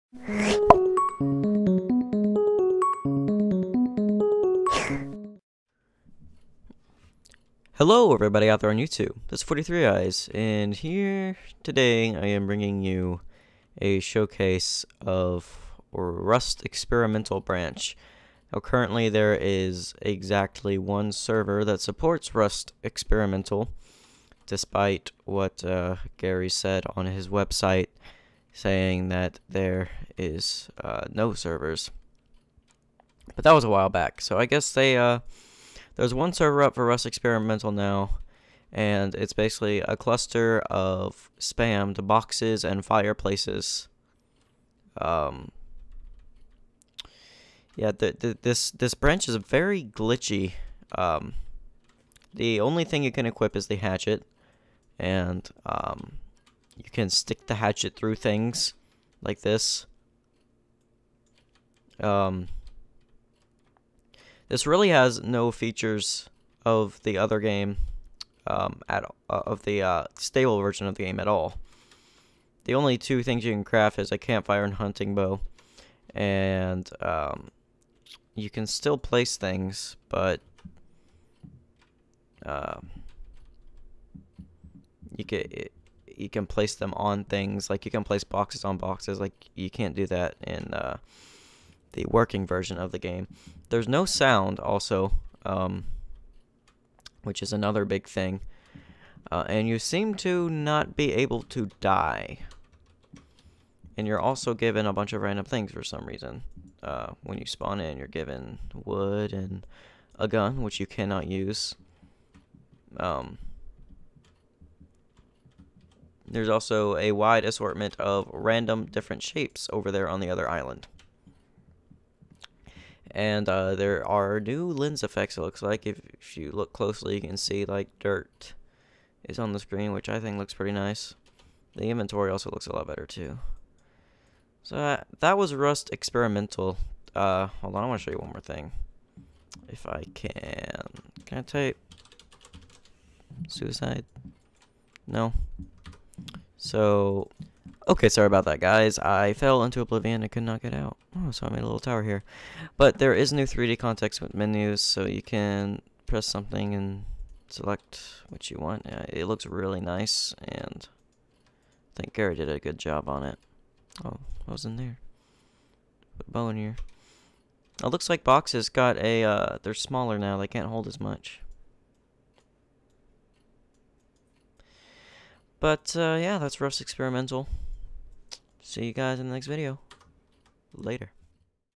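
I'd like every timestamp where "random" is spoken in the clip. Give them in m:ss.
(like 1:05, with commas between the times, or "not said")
1:45, 1:58.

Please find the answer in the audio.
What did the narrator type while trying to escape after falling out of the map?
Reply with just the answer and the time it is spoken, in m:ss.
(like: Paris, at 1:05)
Suicide, at 2:23.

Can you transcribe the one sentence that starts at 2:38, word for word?
Yeah, it looks really nice, and I think Garry did a good job on it.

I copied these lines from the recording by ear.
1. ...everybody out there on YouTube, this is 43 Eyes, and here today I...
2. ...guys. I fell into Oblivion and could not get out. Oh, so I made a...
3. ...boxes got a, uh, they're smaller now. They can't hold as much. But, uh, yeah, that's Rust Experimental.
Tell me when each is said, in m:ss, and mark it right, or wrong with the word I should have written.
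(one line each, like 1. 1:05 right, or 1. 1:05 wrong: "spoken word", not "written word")
1. 0:08 right
2. 2:28 right
3. 2:48 right.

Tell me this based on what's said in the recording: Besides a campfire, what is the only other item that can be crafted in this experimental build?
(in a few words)
hunting bow.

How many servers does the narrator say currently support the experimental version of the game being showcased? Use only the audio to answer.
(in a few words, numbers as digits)
1.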